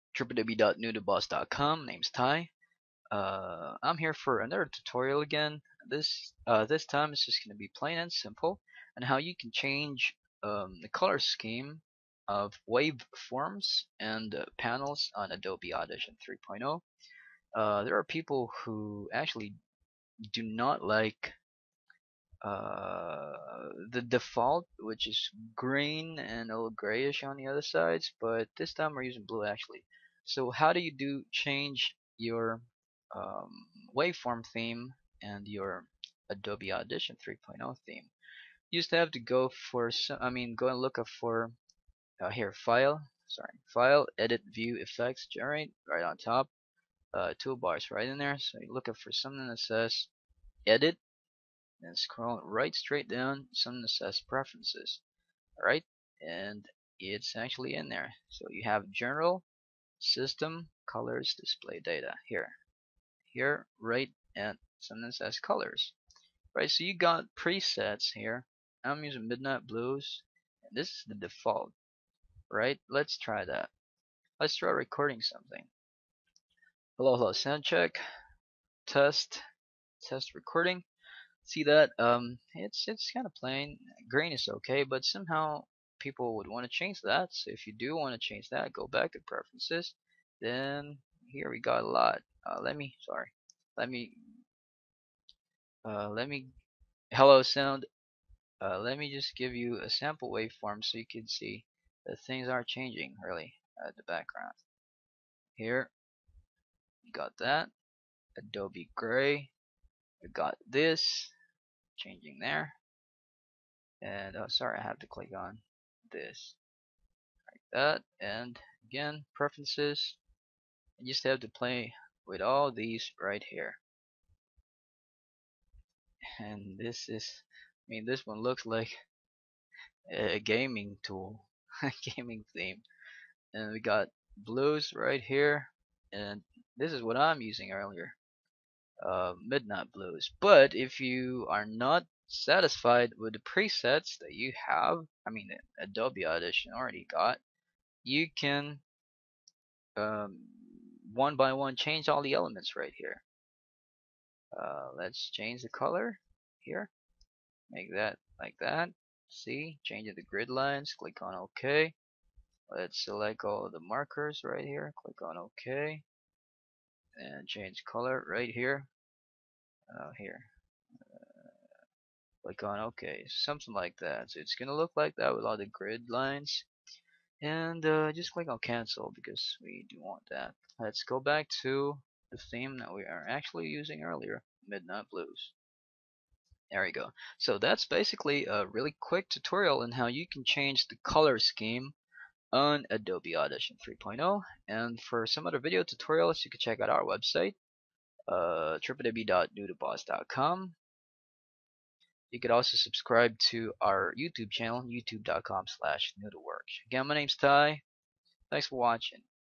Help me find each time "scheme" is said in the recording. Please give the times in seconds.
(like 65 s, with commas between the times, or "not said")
11 s, 191 s.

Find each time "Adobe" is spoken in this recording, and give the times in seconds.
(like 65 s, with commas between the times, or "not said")
15 s, 36 s, 108 s, 145 s, 192 s.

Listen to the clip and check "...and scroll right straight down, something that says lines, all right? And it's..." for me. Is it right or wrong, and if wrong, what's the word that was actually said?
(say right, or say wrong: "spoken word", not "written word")
wrong: "preferences", not "lines".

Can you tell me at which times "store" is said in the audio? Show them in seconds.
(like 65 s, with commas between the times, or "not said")
not said.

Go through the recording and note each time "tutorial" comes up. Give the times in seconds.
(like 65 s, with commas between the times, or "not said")
4 s, 189 s, 195 s.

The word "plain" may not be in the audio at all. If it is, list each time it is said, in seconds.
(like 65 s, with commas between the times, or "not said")
7 s, 83 s.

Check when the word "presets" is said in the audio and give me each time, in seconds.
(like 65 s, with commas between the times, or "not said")
67 s, 143 s.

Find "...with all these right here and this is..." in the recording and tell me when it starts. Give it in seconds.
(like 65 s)
122 s.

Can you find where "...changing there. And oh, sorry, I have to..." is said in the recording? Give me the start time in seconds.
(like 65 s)
111 s.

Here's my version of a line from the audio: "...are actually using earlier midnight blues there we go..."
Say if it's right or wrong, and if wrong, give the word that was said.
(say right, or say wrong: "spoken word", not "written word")
right.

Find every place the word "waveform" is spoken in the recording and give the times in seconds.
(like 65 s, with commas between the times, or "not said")
12 s, 33 s, 100 s.